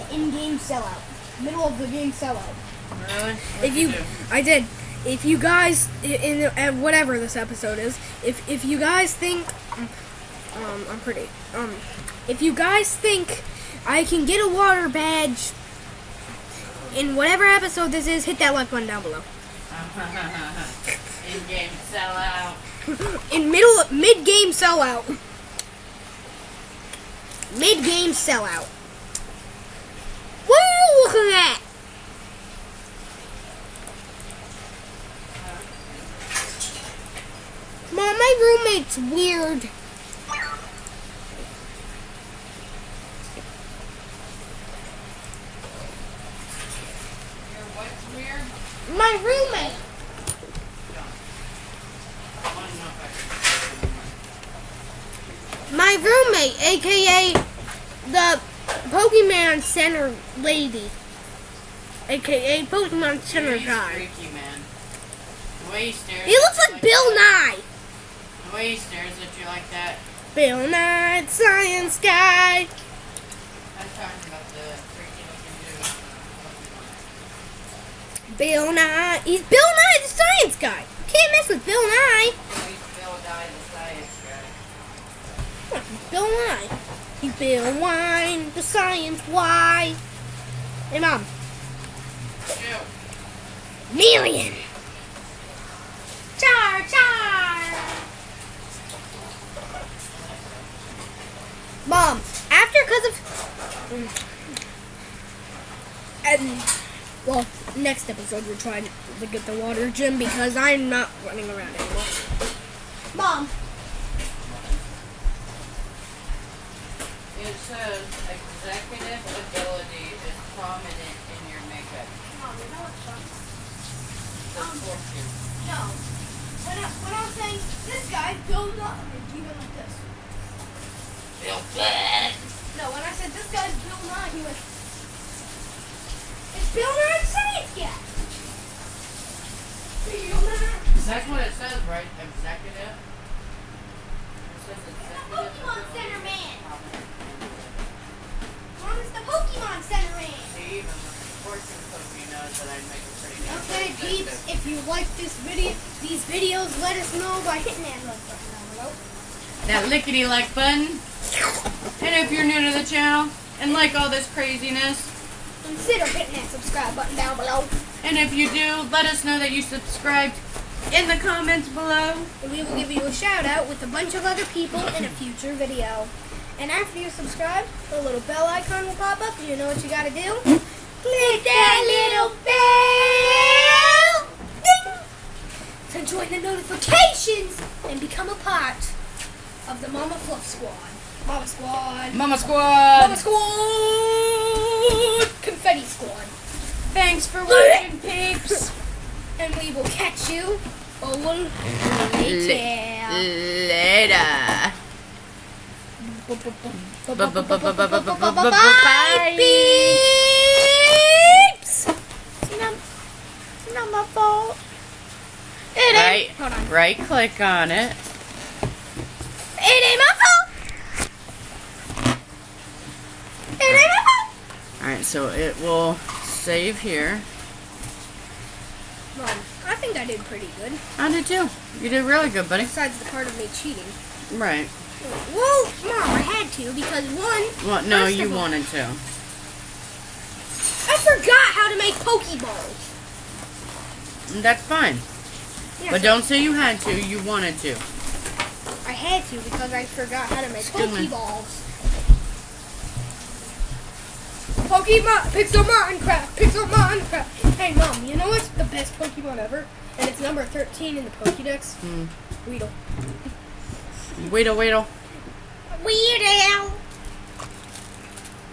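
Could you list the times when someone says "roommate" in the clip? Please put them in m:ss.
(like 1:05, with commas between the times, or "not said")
0:38, 0:49, 0:56.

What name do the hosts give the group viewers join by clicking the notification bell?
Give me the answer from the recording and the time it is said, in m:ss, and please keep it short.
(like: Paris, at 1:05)
Mama Fluff Squad, at 3:09.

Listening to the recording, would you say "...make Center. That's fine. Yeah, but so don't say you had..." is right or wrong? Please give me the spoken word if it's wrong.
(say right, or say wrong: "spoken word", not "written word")
wrong: "Pokeballs", not "Center".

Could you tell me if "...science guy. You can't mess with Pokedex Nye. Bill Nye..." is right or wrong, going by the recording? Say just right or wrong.
wrong.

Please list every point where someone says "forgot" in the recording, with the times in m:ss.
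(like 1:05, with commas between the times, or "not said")
4:00, 4:09.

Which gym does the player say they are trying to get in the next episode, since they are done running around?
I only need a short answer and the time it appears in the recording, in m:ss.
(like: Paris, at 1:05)
water gym, at 1:49.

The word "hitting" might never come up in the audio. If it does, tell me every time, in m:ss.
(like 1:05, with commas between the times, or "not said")
2:37, 2:46.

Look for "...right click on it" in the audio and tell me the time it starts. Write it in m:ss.
3:36.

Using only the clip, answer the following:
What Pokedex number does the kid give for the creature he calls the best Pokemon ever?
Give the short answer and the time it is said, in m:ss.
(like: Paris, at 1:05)
13, at 4:20.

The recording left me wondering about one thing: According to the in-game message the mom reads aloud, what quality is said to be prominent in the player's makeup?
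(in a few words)
executive ability.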